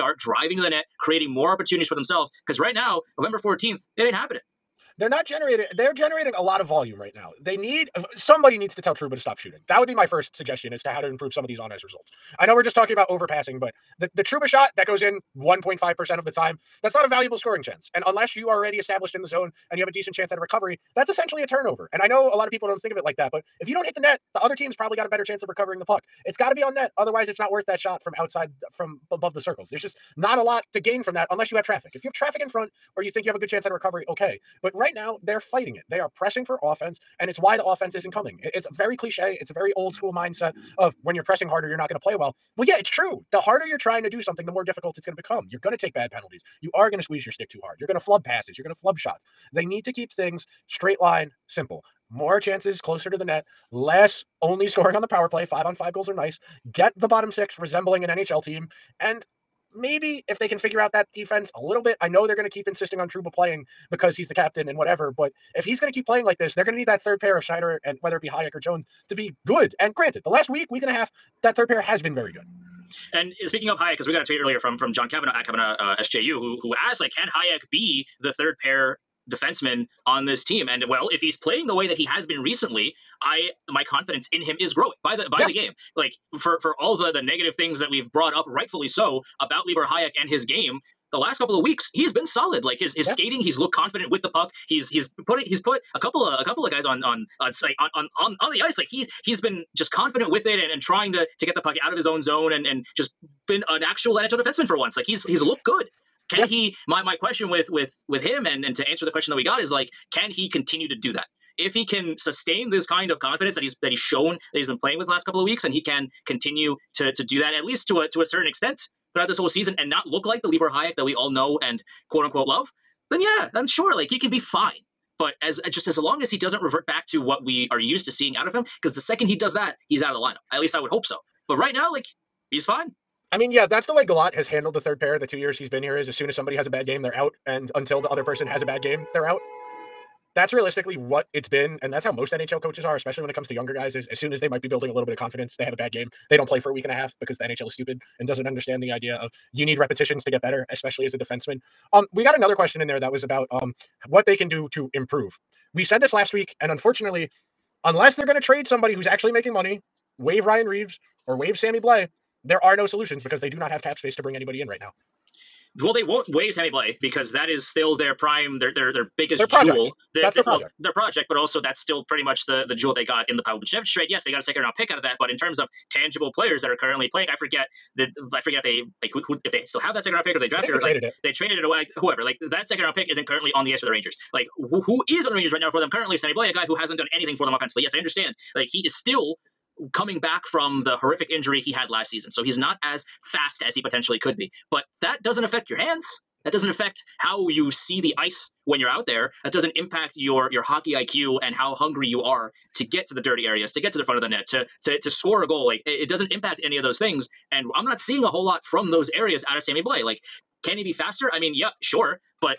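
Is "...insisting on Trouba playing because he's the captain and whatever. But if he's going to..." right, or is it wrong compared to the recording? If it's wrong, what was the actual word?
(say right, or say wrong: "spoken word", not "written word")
right.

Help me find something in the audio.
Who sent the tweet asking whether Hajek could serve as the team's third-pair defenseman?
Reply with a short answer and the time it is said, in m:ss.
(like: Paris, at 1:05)
John Kavanaugh, at 1:14.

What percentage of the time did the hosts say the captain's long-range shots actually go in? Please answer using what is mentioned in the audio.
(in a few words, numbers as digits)
1.5%.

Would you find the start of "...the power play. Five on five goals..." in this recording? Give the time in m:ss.
0:55.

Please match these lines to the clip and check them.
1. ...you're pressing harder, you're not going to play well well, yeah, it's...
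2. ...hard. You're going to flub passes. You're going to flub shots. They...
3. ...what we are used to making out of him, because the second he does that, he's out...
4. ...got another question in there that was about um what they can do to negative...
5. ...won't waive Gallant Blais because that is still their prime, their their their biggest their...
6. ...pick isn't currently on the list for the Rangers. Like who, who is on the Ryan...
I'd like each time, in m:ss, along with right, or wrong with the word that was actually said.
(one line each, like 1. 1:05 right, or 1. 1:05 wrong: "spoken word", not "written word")
1. 0:41 right
2. 0:47 right
3. 2:07 wrong: "seeing", not "making"
4. 2:32 wrong: "improve", not "negative"
5. 2:46 wrong: "Sammy", not "Gallant"
6. 3:02 wrong: "Rangers", not "Ryan".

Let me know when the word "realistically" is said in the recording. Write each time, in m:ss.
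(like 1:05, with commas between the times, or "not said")
2:20.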